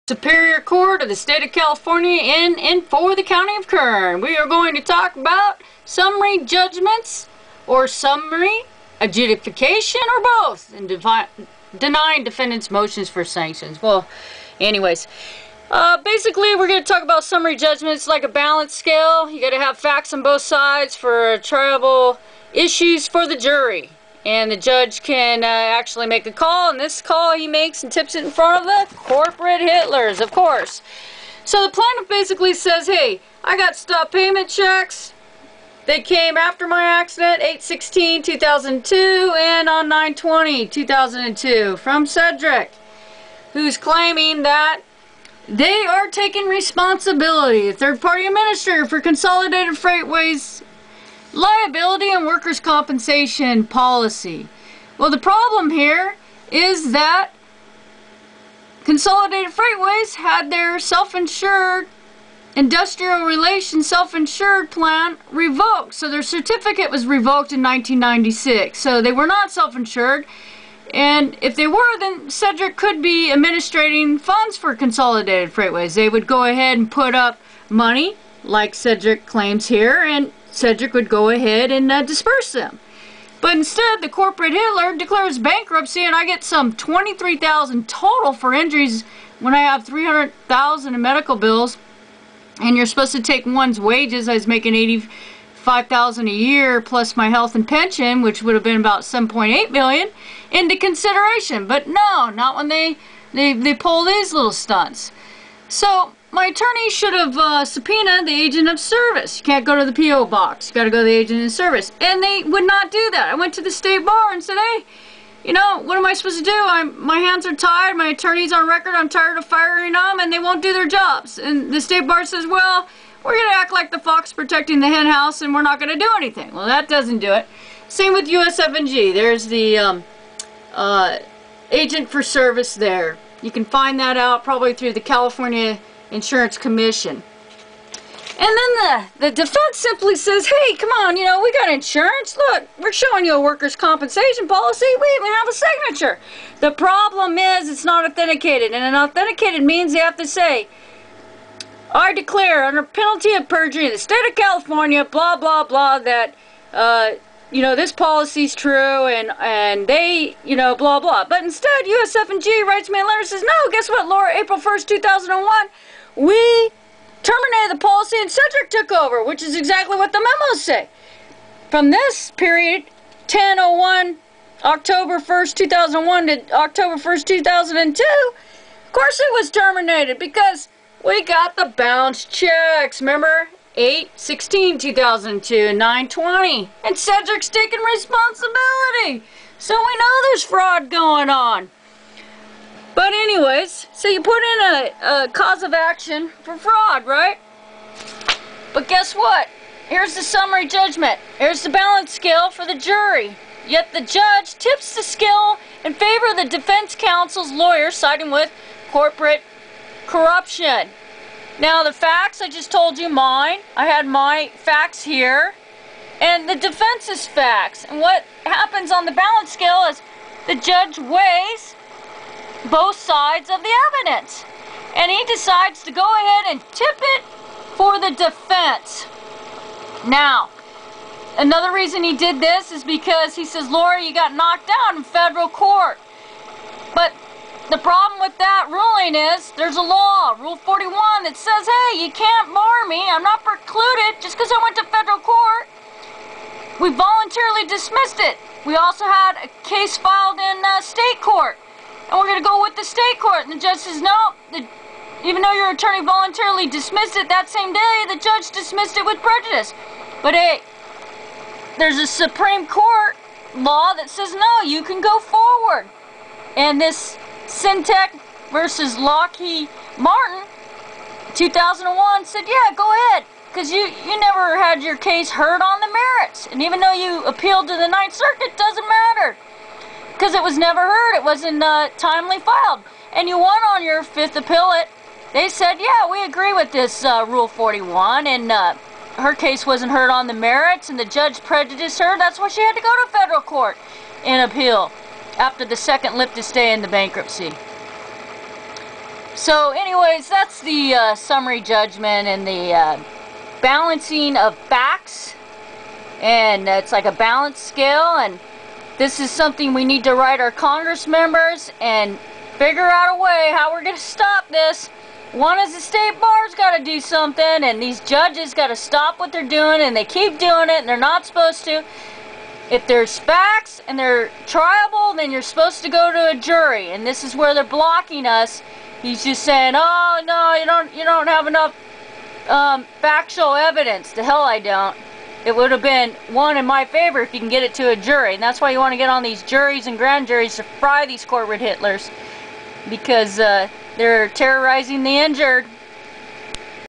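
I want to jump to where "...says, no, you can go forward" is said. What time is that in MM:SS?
04:24.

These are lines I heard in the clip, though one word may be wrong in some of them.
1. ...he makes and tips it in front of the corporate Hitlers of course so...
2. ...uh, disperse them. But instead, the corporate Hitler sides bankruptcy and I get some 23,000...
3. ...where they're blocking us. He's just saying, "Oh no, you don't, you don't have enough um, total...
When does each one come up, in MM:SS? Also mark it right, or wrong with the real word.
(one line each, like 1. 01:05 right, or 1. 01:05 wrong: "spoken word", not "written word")
1. 00:27 right
2. 01:21 wrong: "declares", not "sides"
3. 05:27 wrong: "factual", not "total".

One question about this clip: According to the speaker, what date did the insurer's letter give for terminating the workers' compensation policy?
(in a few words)
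April 1, 2001.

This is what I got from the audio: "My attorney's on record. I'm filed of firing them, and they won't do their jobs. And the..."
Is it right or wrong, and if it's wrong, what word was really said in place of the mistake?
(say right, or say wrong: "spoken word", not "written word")
wrong: "tired", not "filed".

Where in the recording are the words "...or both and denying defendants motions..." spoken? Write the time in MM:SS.
00:10.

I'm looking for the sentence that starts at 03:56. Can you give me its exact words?
But the problem with that point is, there's a law, Rule 41, that says, hey, you can't bar me.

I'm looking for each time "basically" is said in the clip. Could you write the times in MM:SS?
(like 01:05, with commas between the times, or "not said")
00:16, 00:32.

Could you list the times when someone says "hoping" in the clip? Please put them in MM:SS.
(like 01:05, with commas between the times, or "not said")
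not said.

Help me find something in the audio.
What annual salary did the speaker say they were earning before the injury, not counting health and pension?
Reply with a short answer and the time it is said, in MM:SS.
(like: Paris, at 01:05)
$85,000, at 01:34.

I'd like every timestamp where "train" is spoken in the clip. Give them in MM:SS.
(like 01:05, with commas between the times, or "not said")
not said.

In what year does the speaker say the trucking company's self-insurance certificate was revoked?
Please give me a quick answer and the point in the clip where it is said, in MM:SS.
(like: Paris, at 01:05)
1996, at 01:07.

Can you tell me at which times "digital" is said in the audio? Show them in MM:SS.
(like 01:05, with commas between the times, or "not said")
not said.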